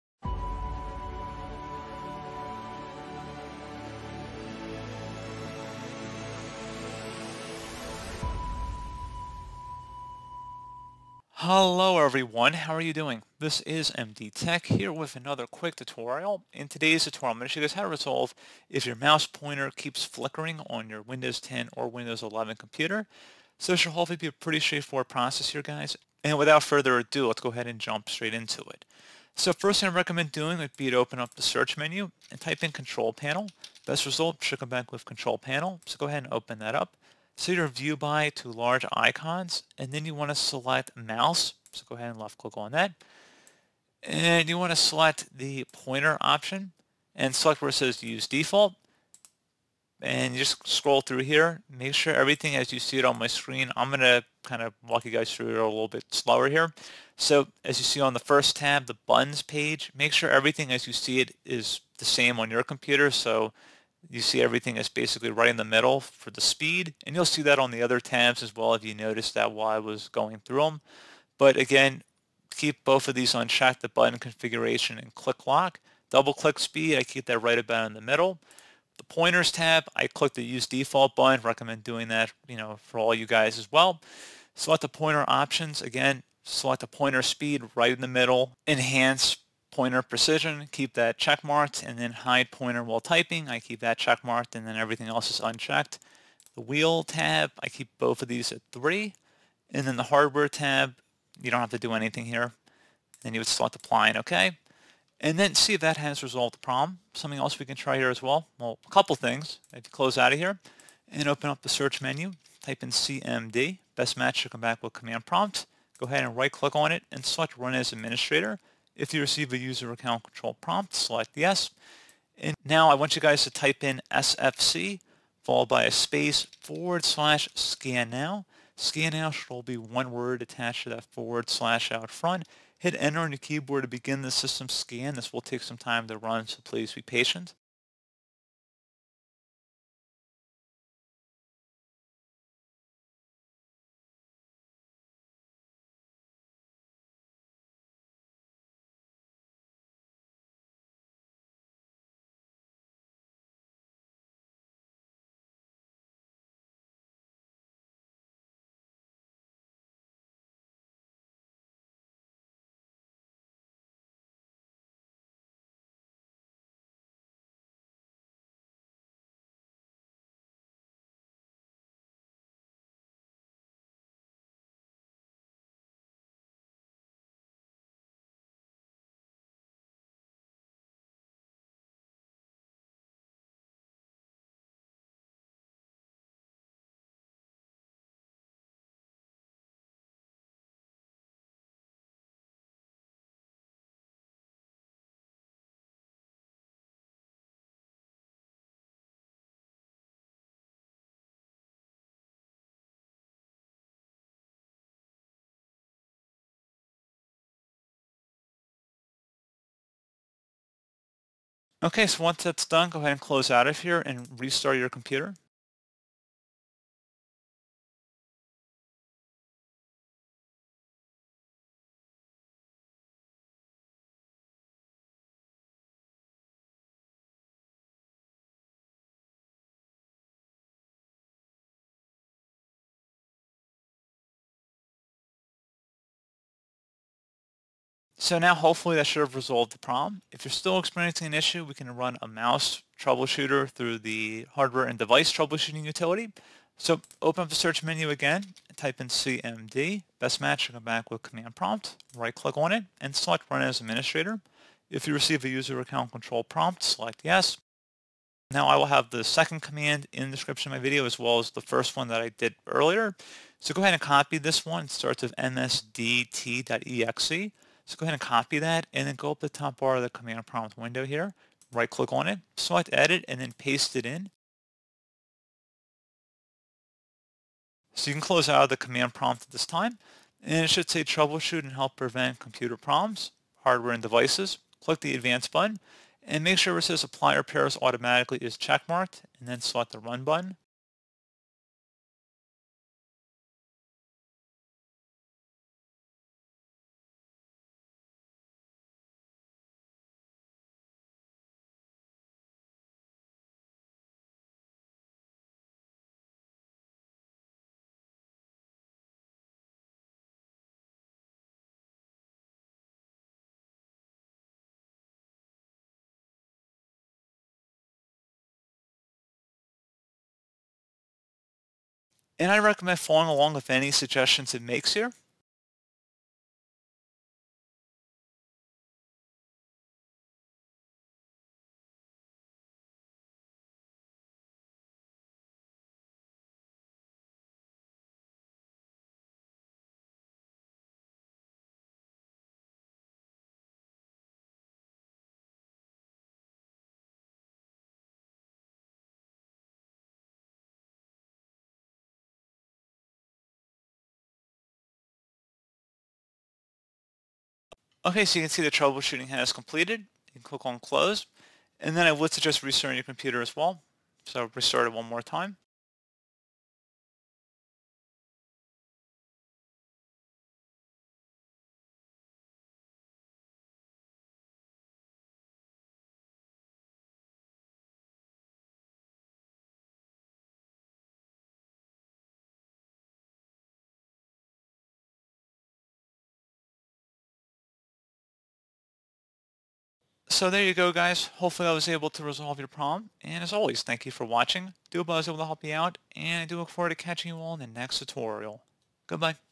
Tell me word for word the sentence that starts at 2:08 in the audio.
Scan now should all be one word attached to that forward slash out front.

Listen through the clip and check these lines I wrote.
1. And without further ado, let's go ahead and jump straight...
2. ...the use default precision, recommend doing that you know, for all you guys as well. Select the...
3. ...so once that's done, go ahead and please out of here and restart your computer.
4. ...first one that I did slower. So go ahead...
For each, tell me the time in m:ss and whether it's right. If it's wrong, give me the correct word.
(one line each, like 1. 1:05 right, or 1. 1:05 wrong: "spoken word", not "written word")
1. 0:26 right
2. 1:20 wrong: "button", not "precision"
3. 3:32 wrong: "close", not "please"
4. 4:21 wrong: "earlier", not "slower".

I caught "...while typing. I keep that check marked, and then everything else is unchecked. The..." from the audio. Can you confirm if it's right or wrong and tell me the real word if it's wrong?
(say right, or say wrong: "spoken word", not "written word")
right.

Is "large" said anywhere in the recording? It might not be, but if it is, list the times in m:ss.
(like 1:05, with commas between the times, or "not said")
0:38.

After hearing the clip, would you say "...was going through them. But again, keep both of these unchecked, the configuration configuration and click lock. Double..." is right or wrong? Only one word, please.
wrong.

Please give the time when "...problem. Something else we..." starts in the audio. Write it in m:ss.
1:46.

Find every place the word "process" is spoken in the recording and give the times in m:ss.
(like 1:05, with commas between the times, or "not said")
0:25.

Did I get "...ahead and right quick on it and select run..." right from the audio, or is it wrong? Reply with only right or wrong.
wrong.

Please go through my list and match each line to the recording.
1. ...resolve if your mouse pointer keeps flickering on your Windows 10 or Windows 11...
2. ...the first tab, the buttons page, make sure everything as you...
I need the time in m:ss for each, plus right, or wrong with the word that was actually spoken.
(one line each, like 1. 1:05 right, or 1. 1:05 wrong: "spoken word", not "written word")
1. 0:17 right
2. 0:58 right.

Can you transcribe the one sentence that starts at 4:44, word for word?
Click the advanced button and make sure it says apply repairs automatically is checkmarked and then select the run button.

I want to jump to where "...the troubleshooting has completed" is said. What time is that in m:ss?
5:58.